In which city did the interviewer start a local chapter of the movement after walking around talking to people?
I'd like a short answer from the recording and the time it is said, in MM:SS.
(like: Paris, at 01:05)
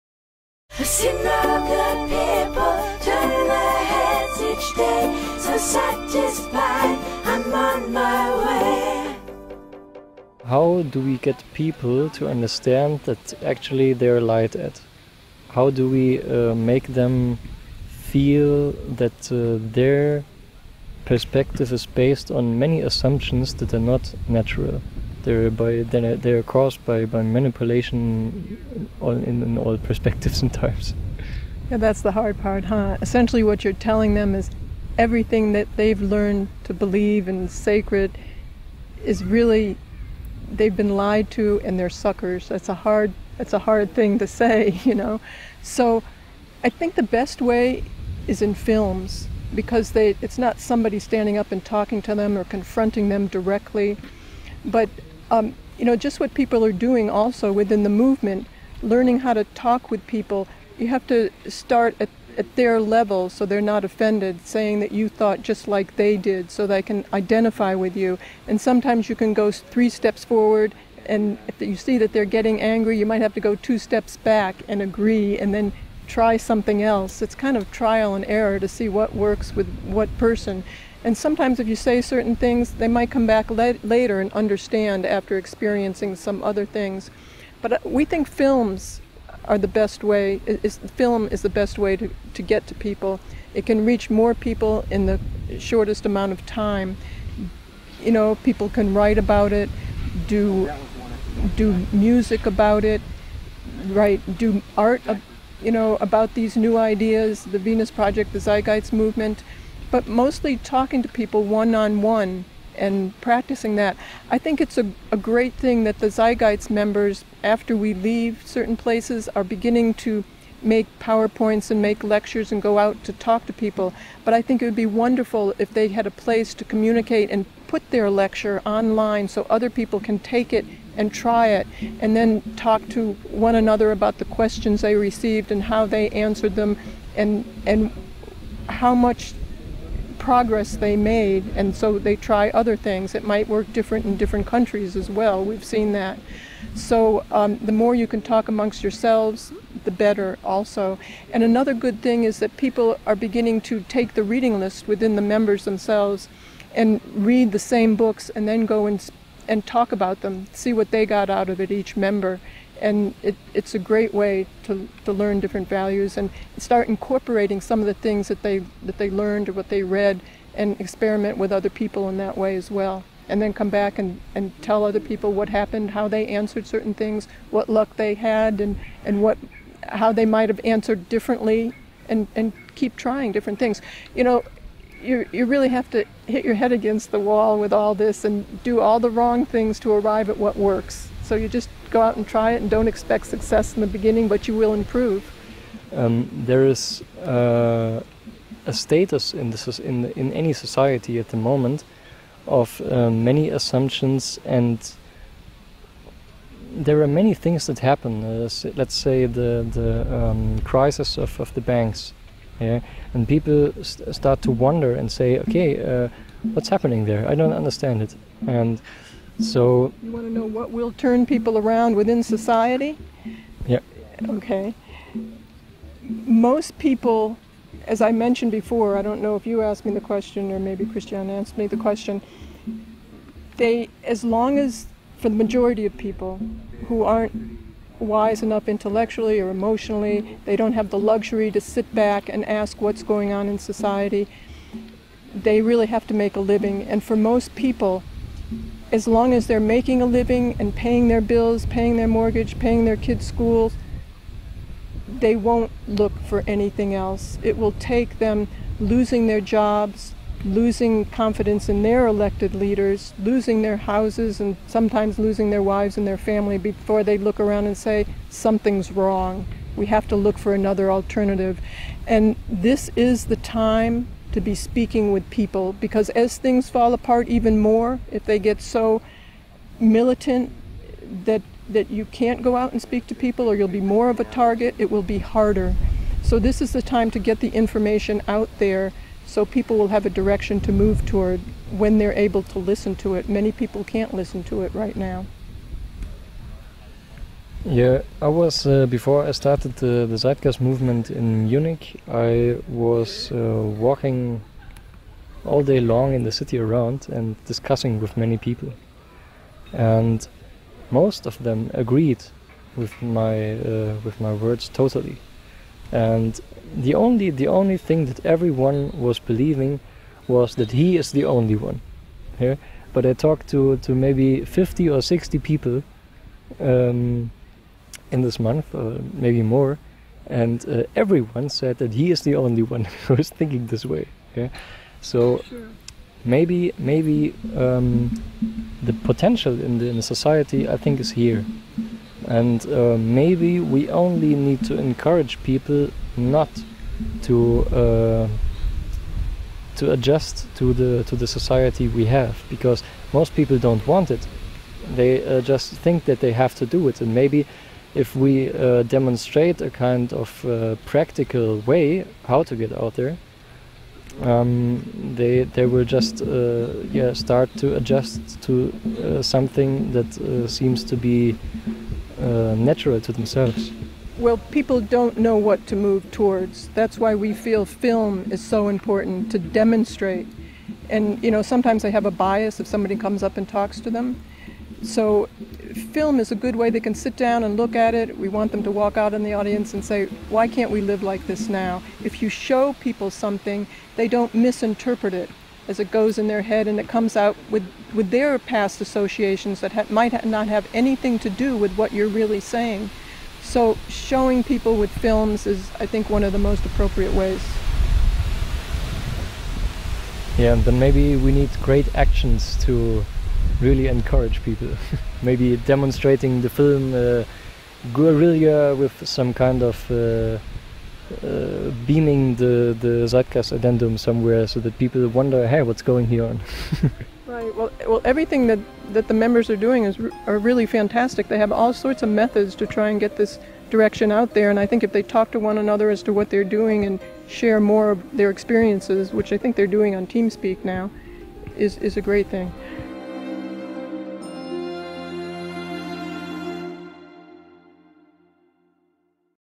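Munich, at 05:01.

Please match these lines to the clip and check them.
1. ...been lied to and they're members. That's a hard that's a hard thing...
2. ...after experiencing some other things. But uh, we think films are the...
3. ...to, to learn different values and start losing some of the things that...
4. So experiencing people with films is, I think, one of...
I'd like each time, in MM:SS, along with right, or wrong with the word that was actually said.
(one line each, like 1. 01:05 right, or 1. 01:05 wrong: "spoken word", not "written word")
1. 00:40 wrong: "suckers", not "members"
2. 01:25 right
3. 02:44 wrong: "incorporating", not "losing"
4. 06:43 wrong: "showing", not "experiencing".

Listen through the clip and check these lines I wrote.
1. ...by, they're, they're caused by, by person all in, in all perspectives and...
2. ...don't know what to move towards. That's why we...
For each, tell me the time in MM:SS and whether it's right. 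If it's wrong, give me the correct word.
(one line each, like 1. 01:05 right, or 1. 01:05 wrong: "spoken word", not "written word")
1. 00:25 wrong: "manipulation", not "person"
2. 06:14 right.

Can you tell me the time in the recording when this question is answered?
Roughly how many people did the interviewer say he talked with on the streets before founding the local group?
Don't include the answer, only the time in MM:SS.
05:24.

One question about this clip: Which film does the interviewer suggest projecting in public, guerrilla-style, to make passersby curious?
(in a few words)
Zeitgeist Addendum.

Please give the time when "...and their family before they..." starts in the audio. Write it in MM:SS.
04:25.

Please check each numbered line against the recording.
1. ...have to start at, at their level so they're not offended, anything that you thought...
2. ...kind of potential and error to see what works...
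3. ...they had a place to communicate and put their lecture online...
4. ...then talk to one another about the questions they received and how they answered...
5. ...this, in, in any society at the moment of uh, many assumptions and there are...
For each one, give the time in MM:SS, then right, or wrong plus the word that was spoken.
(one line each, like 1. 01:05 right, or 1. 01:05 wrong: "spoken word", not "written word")
1. 01:00 wrong: "saying", not "anything"
2. 01:17 wrong: "trial", not "potential"
3. 02:05 right
4. 02:12 right
5. 03:19 right.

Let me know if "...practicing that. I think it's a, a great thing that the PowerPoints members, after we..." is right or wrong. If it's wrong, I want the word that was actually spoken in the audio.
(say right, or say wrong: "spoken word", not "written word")
wrong: "Zeitgeist", not "PowerPoints".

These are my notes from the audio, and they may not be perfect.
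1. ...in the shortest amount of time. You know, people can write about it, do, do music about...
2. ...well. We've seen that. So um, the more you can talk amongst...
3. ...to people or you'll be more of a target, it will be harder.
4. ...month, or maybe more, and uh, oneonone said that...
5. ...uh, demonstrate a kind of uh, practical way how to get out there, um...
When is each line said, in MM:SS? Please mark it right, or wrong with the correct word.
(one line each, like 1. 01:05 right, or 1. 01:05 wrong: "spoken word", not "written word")
1. 01:34 right
2. 02:25 right
3. 04:43 right
4. 05:28 wrong: "everyone", not "oneonone"
5. 05:58 right.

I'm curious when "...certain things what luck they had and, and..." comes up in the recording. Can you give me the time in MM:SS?
02:56.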